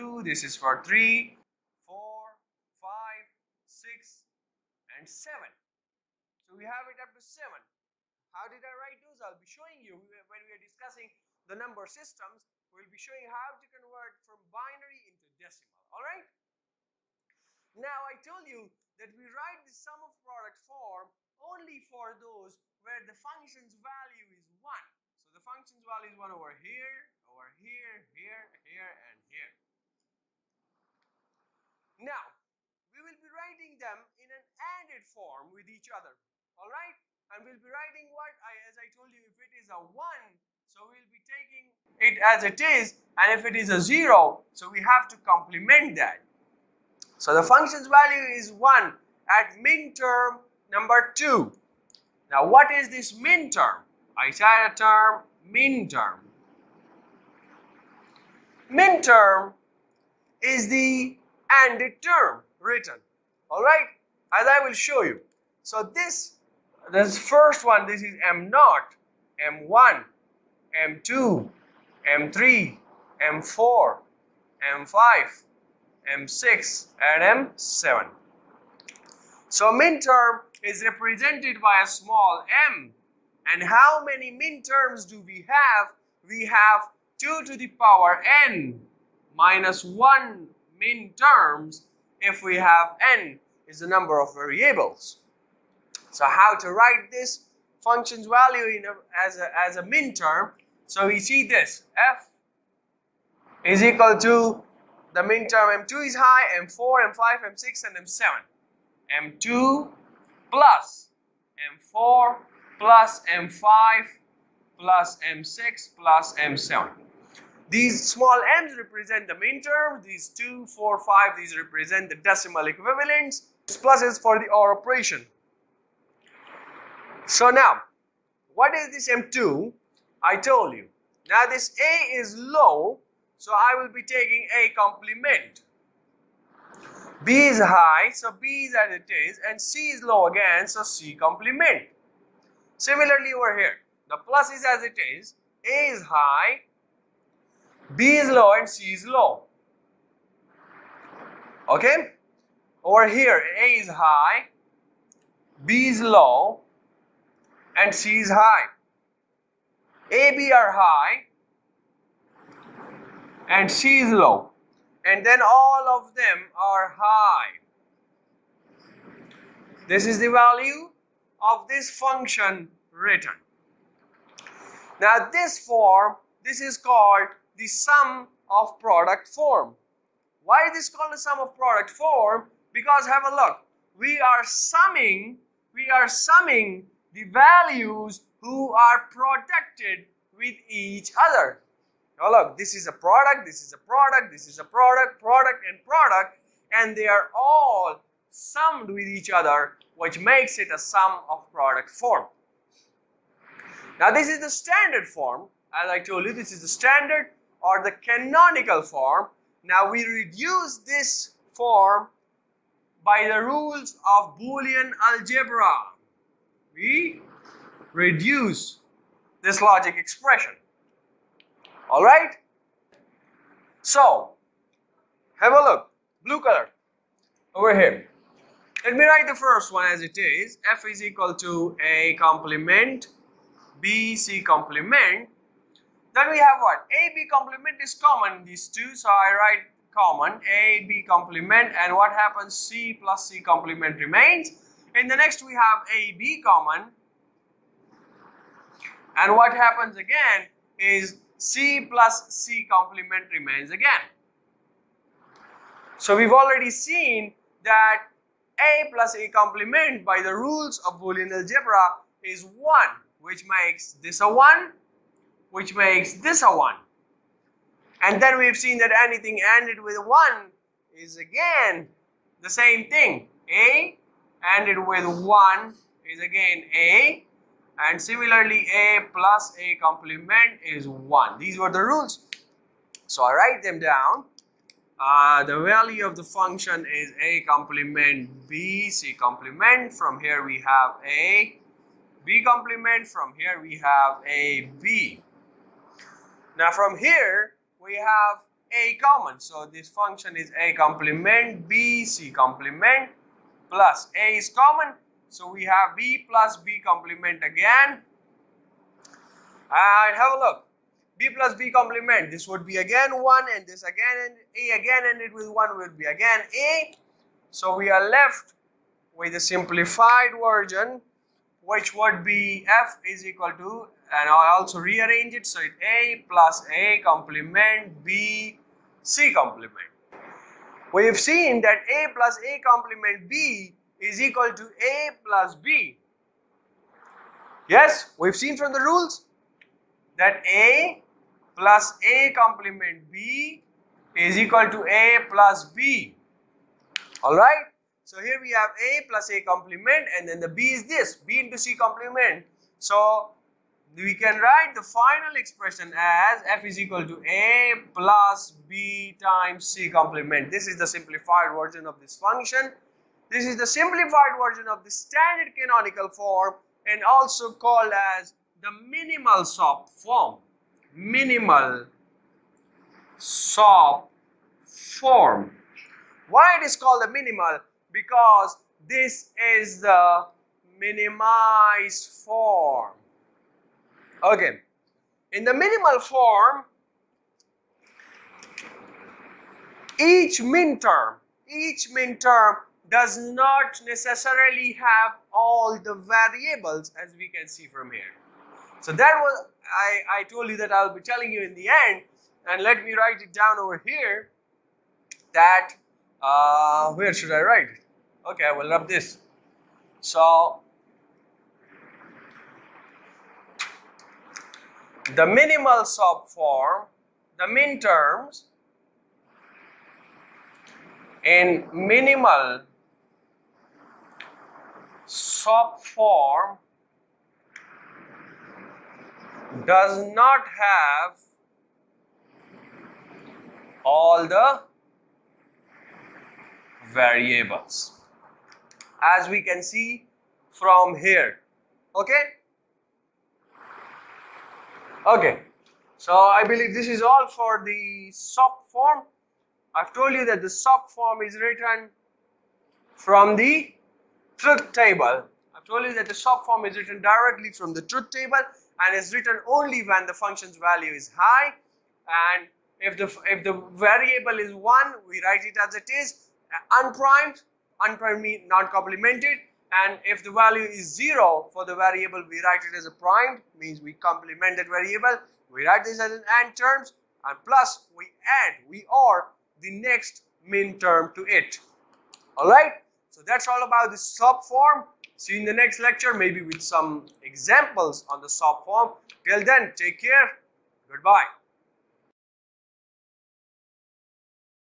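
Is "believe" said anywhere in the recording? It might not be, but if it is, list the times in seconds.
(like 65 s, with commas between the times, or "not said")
446 s.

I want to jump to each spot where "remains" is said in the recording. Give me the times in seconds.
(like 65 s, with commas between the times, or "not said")
243 s, 253 s.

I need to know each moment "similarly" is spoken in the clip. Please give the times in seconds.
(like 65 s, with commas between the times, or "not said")
142 s, 278 s.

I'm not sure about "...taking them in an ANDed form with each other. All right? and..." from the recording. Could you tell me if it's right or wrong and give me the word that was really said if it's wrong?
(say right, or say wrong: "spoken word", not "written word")
wrong: "writing", not "taking".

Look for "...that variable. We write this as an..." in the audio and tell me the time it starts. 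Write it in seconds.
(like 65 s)
474 s.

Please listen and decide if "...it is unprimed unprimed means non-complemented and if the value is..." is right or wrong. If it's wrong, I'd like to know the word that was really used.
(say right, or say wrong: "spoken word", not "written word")
right.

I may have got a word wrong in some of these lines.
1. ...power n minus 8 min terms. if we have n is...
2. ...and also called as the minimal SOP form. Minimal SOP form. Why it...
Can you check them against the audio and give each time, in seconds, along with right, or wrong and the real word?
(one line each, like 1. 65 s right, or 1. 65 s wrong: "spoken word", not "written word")
1. 87 s wrong: "1", not "8"
2. 366 s right.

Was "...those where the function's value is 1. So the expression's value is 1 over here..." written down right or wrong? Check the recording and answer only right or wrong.
wrong.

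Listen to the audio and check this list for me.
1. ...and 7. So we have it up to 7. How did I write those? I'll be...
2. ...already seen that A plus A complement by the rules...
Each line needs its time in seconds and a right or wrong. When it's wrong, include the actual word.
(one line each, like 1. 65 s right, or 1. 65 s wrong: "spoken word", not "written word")
1. 4 s right
2. 256 s right.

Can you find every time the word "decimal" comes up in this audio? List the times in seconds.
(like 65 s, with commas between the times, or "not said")
15 s, 122 s.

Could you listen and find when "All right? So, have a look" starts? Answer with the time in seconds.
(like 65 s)
221 s.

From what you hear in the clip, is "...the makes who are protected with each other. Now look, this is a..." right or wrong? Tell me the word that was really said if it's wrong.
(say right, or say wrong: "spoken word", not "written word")
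wrong: "values", not "makes".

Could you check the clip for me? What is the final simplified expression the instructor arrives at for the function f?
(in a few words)
A plus B times C complement.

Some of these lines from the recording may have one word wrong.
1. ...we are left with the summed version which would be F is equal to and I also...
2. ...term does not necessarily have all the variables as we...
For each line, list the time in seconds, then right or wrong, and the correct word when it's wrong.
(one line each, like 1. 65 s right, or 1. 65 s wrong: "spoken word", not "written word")
1. 317 s wrong: "simplified", not "summed"
2. 392 s right.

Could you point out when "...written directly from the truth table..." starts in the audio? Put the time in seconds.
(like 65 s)
456 s.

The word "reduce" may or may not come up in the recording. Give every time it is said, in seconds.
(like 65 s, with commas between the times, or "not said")
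210 s, 217 s.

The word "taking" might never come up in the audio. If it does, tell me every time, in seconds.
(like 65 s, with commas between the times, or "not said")
41 s, 134 s.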